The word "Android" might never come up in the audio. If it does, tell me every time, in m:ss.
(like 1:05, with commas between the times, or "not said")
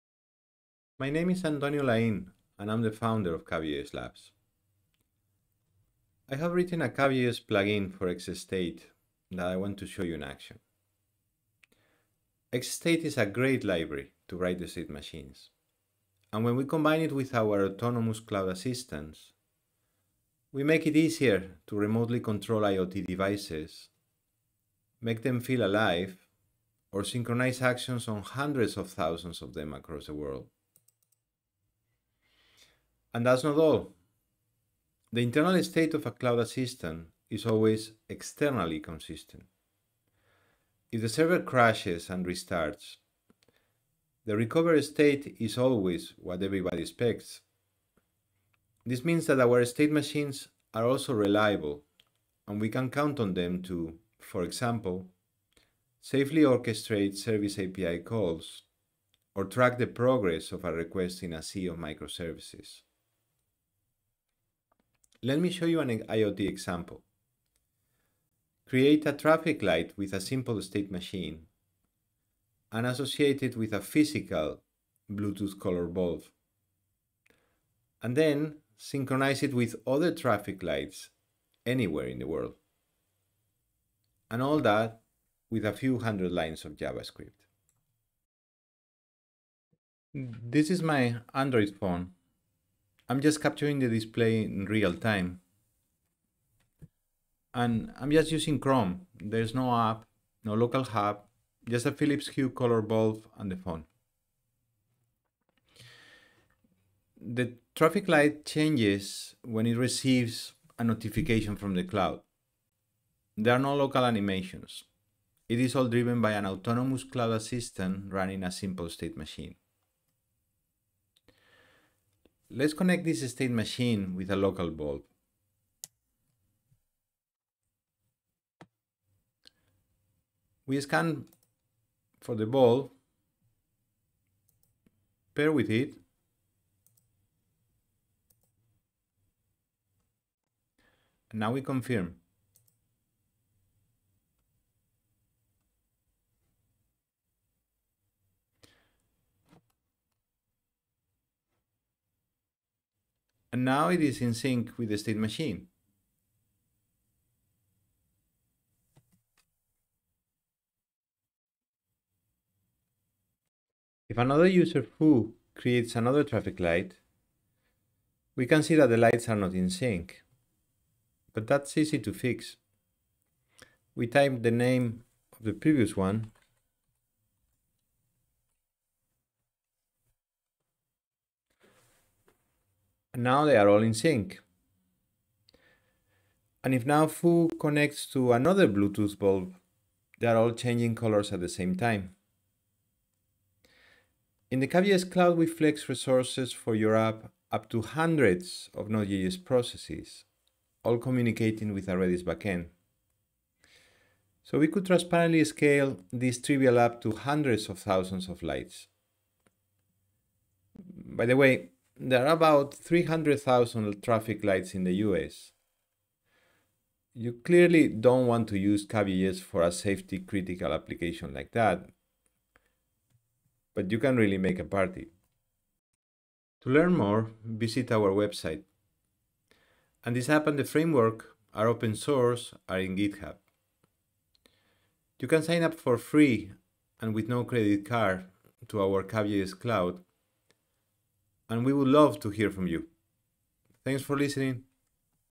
1:31.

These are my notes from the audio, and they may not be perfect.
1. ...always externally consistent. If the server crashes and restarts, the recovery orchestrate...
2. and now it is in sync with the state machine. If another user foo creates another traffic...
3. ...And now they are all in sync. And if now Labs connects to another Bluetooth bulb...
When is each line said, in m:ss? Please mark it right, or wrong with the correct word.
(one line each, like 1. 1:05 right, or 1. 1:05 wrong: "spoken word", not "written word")
1. 0:37 wrong: "state", not "orchestrate"
2. 2:33 right
3. 3:03 wrong: "Foo", not "Labs".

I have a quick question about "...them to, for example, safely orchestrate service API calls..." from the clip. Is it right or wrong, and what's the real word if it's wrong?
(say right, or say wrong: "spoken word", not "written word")
right.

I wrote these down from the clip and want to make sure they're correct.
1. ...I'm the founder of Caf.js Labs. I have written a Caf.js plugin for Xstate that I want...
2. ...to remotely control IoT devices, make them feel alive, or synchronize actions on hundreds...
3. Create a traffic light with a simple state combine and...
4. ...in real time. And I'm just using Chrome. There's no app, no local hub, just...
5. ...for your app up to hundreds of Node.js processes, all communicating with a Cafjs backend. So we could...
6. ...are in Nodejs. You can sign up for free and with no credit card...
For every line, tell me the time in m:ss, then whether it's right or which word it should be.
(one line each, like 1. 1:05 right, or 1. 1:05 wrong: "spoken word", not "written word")
1. 0:02 right
2. 0:21 right
3. 1:08 wrong: "machine", not "combine"
4. 1:34 right
5. 3:16 wrong: "Redis", not "Cafjs"
6. 3:52 wrong: "GitHub", not "Nodejs".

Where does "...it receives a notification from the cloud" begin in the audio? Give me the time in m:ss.
1:49.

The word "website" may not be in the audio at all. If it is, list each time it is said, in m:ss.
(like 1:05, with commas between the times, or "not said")
3:48.